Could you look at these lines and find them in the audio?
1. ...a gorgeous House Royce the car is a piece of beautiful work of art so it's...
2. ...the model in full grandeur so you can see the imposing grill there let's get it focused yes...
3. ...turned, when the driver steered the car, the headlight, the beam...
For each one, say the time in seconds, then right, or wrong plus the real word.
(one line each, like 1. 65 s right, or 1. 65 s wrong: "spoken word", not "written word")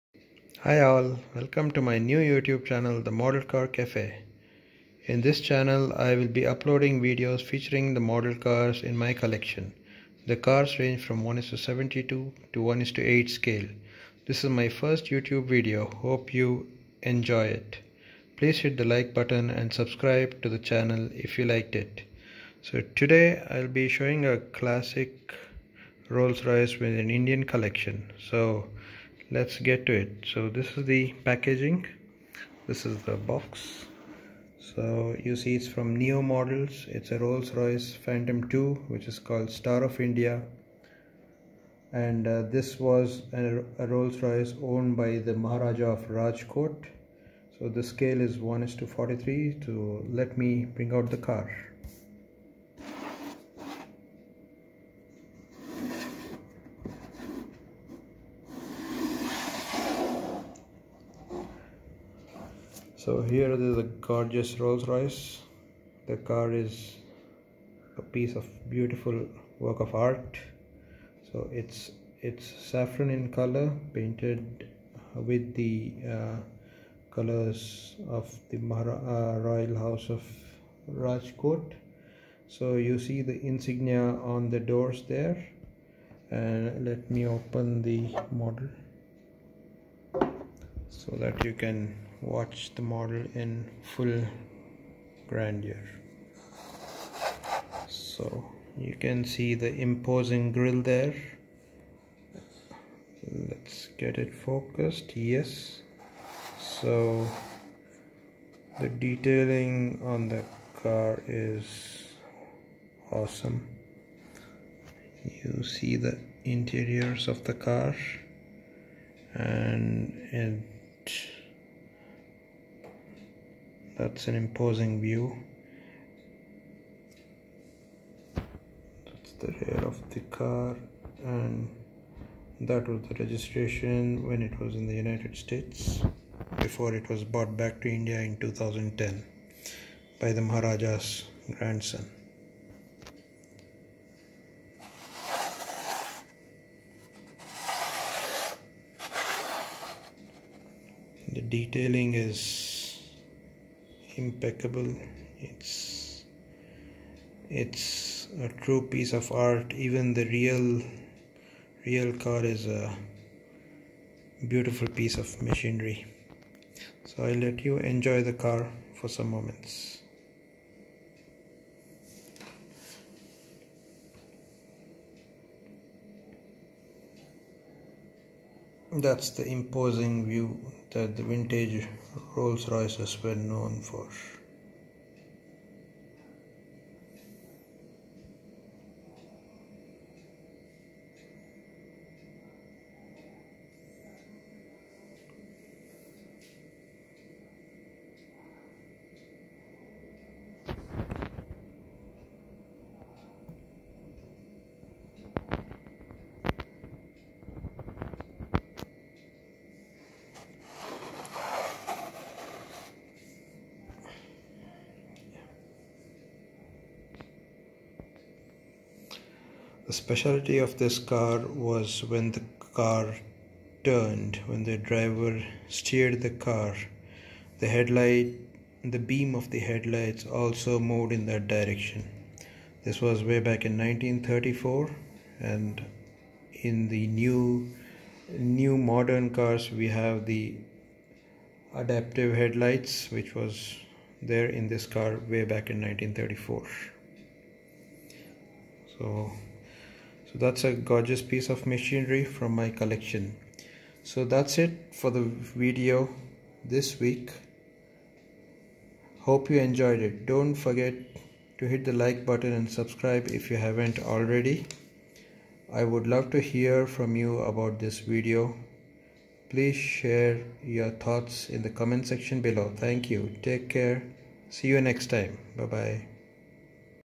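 1. 63 s wrong: "Rolls", not "House"
2. 92 s right
3. 223 s right.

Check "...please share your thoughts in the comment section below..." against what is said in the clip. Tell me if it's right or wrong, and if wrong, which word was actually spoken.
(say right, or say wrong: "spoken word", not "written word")
right.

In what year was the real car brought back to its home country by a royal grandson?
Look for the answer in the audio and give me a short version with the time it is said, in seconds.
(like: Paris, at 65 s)
2010, at 138 s.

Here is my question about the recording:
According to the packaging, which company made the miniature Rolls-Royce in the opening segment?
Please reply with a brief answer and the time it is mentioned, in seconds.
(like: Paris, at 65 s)
Neo models, at 35 s.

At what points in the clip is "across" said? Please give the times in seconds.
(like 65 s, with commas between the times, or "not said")
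not said.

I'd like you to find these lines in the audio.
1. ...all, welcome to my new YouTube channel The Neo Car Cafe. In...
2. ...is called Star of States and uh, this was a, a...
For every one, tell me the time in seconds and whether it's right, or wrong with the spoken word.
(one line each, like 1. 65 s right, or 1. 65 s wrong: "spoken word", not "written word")
1. 0 s wrong: "Model", not "Neo"
2. 39 s wrong: "India", not "States".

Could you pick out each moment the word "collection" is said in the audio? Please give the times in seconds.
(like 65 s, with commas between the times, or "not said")
9 s, 27 s, 252 s.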